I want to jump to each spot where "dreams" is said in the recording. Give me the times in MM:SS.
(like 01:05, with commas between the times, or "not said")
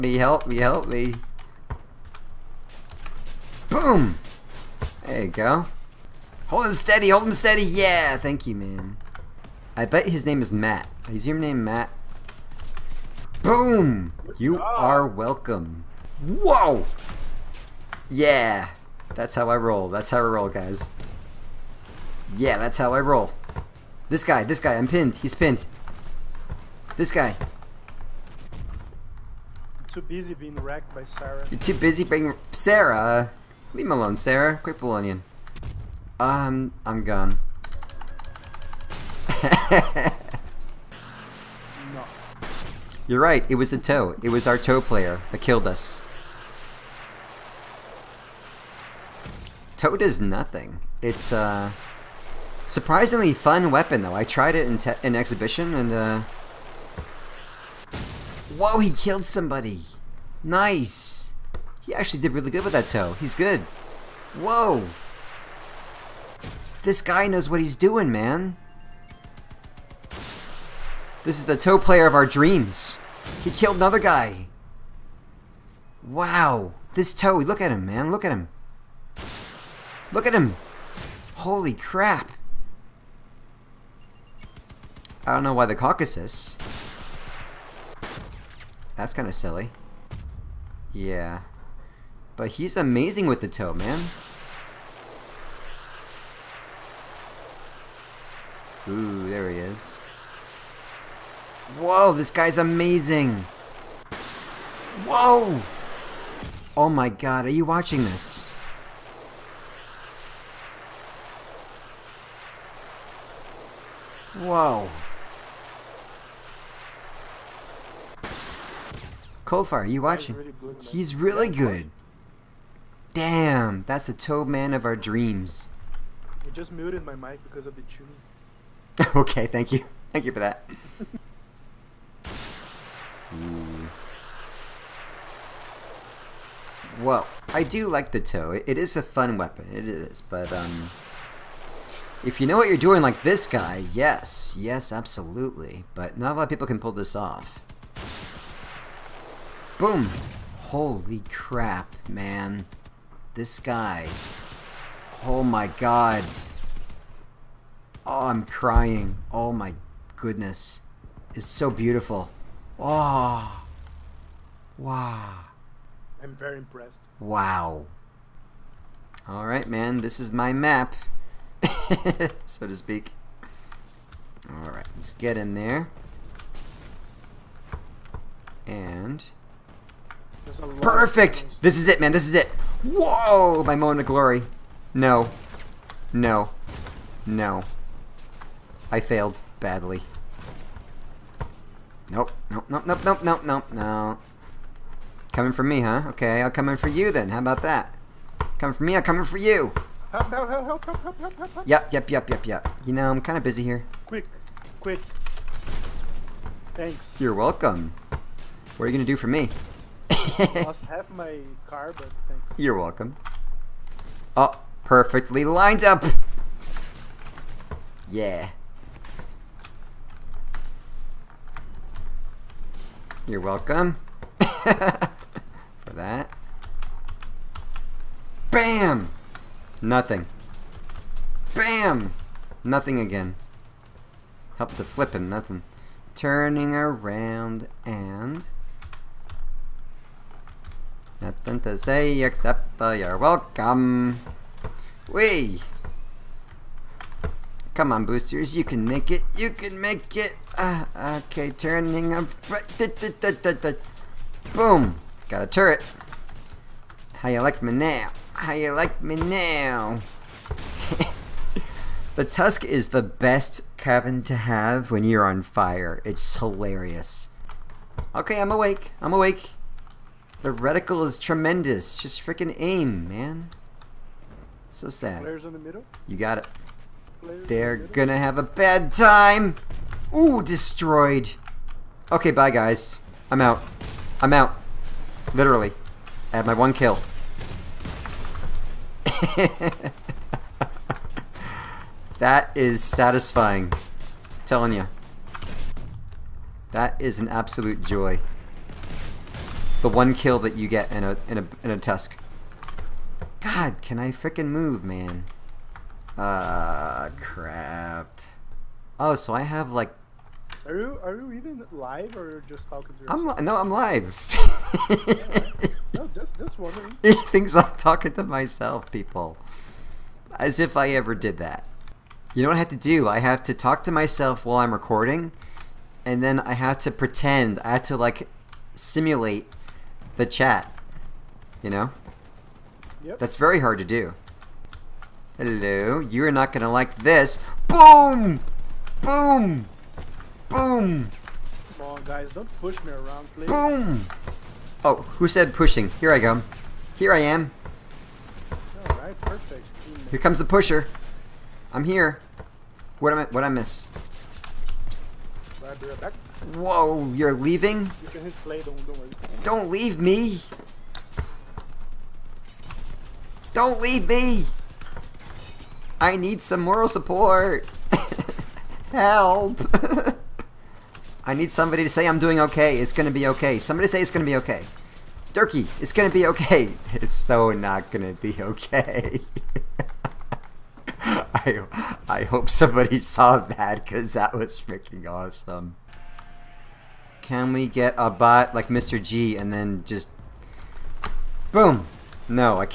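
01:12, 02:04.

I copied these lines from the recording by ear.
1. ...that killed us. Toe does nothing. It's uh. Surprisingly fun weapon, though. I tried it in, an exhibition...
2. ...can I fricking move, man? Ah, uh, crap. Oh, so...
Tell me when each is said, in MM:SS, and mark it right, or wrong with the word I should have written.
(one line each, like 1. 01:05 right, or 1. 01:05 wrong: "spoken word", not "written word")
1. 00:45 right
2. 05:03 right.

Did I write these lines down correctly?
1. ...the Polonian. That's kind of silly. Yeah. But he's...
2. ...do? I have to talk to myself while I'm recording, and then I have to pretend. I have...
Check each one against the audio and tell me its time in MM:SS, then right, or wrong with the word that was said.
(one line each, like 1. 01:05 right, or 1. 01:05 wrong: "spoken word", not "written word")
1. 01:25 wrong: "Caucasus", not "Polonian"
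2. 05:22 right.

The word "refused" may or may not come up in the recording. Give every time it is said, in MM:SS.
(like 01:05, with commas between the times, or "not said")
not said.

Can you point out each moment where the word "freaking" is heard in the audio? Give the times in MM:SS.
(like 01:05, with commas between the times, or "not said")
04:32, 06:24.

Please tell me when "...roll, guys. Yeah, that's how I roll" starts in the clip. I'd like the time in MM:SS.
00:20.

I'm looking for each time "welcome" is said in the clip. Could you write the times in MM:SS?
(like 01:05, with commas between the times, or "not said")
00:15, 03:27, 03:32, 03:43, 04:03.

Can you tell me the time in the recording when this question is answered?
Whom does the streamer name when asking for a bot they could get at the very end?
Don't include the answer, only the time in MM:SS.
06:28.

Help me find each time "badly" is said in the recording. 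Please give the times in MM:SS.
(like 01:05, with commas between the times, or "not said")
03:09.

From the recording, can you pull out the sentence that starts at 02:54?
All right, let's get in there.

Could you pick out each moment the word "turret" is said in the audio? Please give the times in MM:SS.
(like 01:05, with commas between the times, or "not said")
04:15.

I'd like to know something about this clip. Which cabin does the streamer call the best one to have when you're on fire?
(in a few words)
The tusk.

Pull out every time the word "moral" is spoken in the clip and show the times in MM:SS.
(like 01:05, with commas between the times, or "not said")
06:06.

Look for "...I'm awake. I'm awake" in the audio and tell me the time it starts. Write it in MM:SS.
04:28.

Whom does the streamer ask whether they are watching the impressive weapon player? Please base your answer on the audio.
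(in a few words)
Coldfire.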